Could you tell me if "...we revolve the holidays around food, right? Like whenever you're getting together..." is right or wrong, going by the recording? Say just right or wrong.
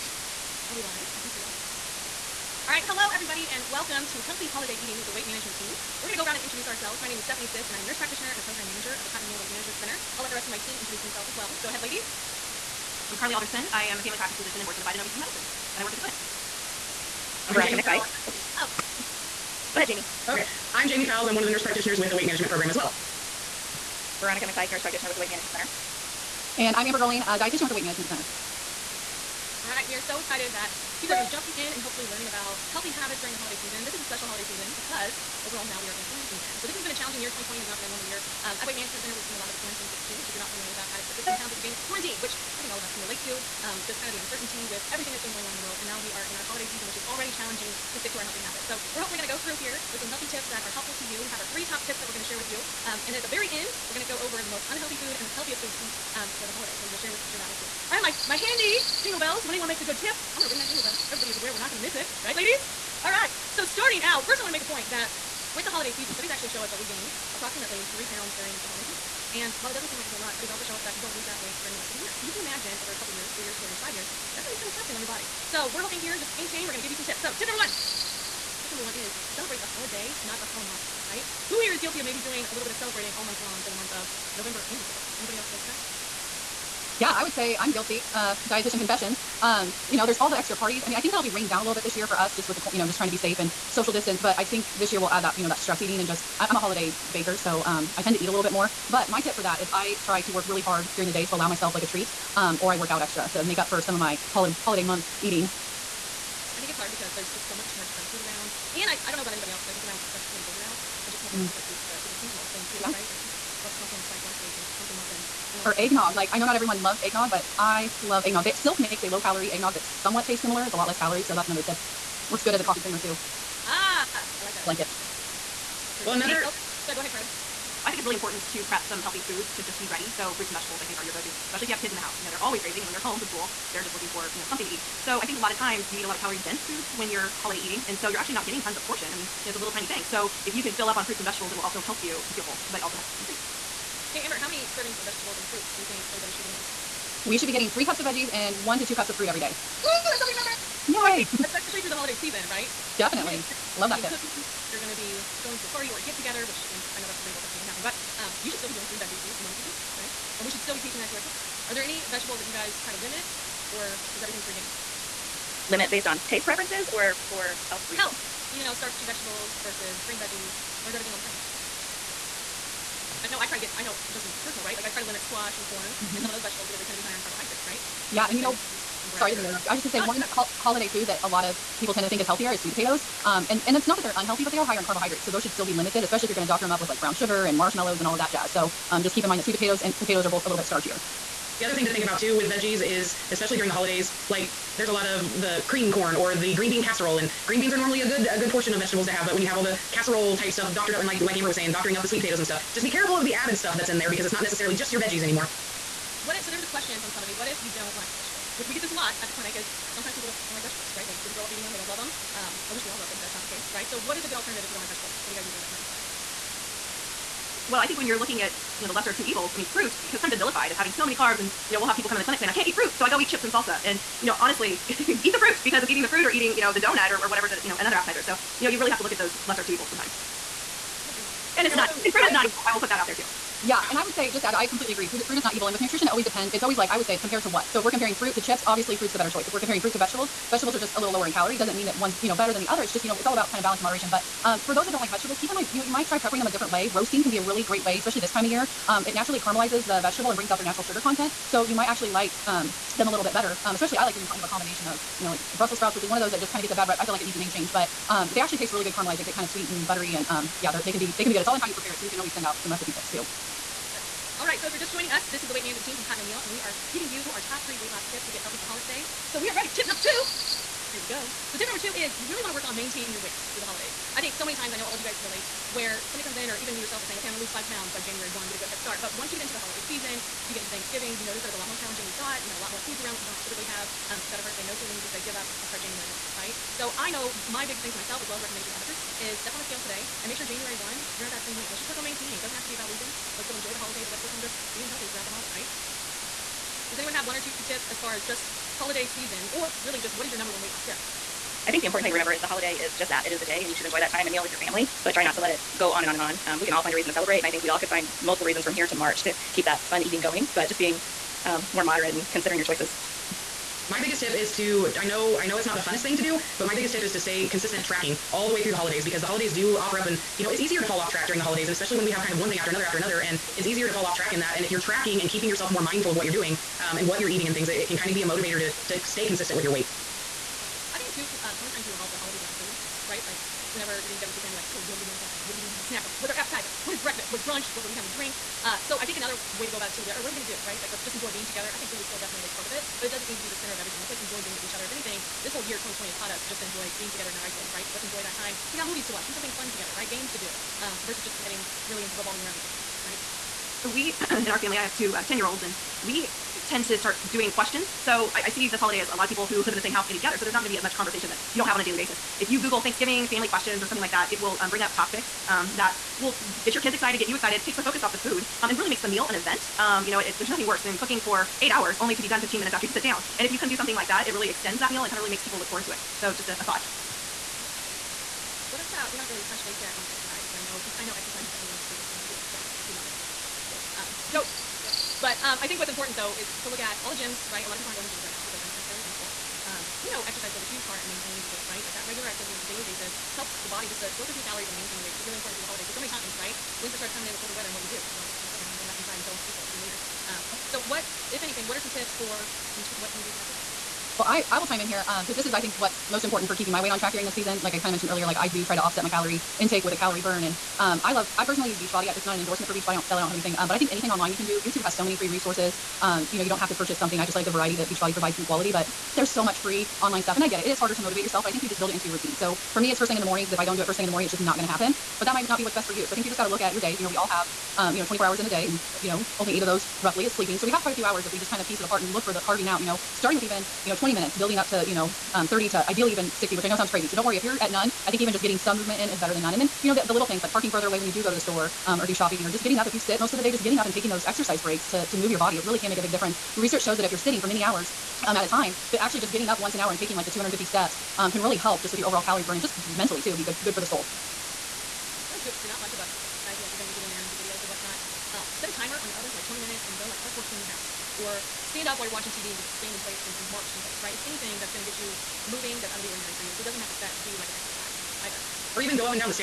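right.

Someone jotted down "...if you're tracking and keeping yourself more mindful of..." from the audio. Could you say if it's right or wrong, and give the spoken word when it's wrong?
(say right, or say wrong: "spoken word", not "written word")
right.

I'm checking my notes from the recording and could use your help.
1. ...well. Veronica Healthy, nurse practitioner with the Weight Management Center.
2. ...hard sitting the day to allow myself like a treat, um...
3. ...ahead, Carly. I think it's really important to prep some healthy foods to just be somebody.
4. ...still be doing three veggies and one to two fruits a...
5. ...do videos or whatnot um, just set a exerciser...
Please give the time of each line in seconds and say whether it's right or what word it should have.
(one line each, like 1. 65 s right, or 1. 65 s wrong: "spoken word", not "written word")
1. 22 s wrong: "McPike", not "Healthy"
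2. 100 s wrong: "during", not "sitting"
3. 127 s wrong: "ready", not "somebody"
4. 158 s right
5. 457 s wrong: "timer", not "exerciser".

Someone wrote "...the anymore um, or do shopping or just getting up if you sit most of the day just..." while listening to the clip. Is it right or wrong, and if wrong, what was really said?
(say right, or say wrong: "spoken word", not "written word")
wrong: "store", not "anymore".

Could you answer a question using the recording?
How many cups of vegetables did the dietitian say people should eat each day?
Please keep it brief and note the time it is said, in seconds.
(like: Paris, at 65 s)
3 cups, at 147 s.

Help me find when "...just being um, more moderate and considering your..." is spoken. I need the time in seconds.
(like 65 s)
310 s.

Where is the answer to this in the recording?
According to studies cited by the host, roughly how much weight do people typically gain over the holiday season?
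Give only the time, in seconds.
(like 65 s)
67 s.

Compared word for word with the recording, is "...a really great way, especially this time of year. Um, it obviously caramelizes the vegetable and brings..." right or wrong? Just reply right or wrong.
wrong.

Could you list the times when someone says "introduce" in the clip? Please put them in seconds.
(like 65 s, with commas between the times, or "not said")
6 s, 10 s.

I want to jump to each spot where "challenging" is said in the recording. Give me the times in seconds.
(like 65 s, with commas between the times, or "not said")
36 s, 47 s, 281 s.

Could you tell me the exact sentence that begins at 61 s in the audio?
Everybody is aware we're not going to miss it.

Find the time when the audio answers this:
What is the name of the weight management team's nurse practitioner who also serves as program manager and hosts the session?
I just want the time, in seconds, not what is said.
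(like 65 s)
7 s.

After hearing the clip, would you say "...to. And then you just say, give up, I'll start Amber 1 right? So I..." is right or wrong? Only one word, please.
wrong.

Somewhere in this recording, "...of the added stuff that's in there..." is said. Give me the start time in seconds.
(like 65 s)
203 s.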